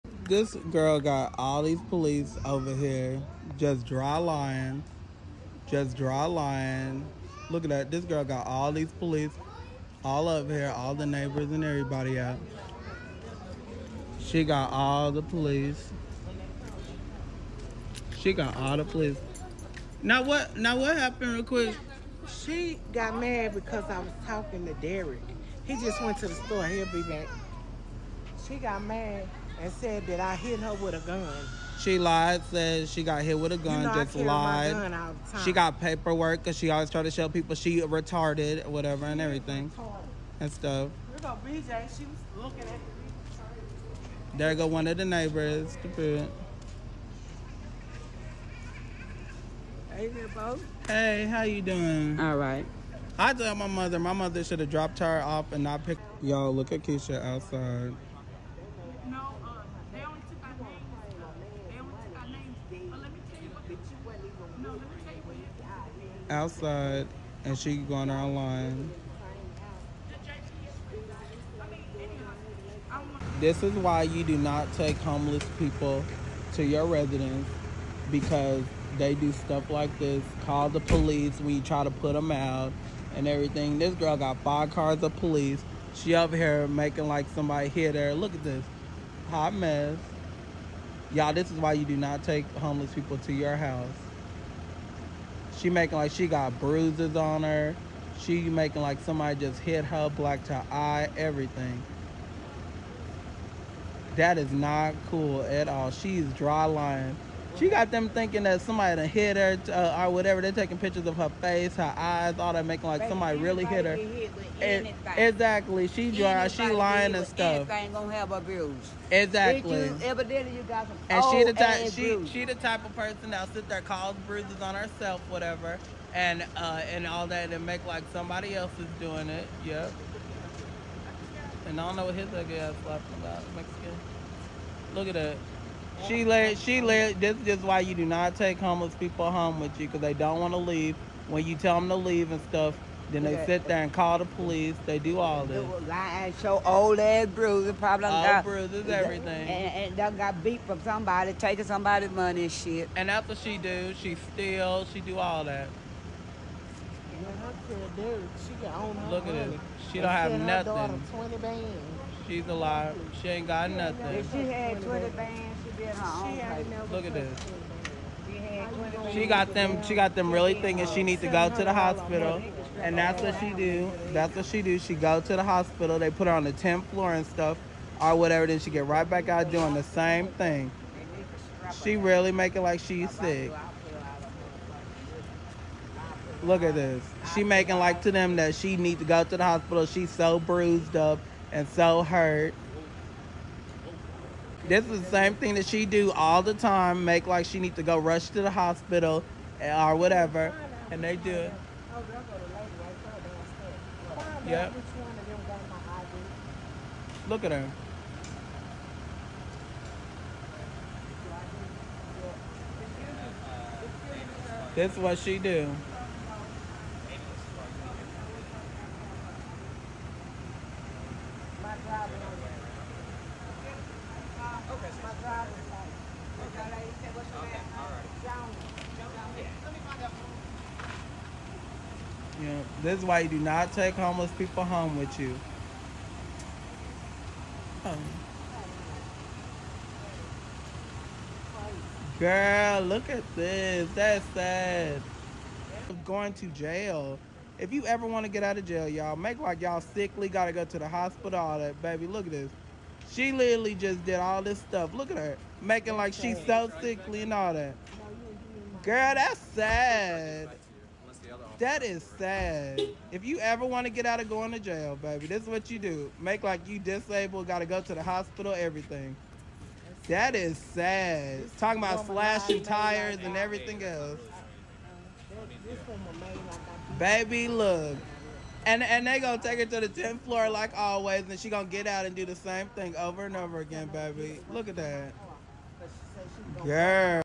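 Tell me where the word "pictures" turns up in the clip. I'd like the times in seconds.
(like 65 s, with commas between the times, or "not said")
110 s.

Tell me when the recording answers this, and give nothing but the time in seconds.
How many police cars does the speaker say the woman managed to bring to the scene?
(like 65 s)
84 s.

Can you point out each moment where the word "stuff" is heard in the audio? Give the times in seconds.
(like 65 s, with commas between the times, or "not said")
40 s, 79 s, 117 s, 142 s, 177 s, 254 s.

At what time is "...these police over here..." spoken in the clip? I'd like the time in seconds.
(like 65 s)
1 s.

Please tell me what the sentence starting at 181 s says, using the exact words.
She really make it like she's sick.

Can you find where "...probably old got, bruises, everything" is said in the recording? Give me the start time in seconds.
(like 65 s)
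147 s.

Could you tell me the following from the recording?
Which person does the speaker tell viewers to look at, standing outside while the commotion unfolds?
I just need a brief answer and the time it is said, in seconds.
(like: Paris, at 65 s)
Keisha, at 56 s.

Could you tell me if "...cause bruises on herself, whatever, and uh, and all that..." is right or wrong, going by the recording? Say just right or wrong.
right.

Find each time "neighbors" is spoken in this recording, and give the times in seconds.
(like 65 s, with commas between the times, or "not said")
11 s, 45 s.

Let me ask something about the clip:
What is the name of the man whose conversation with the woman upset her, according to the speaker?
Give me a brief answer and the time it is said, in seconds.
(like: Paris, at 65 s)
Derek, at 24 s.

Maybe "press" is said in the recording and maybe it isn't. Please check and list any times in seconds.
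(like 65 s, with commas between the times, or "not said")
not said.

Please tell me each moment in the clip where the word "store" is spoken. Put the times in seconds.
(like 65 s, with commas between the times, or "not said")
26 s.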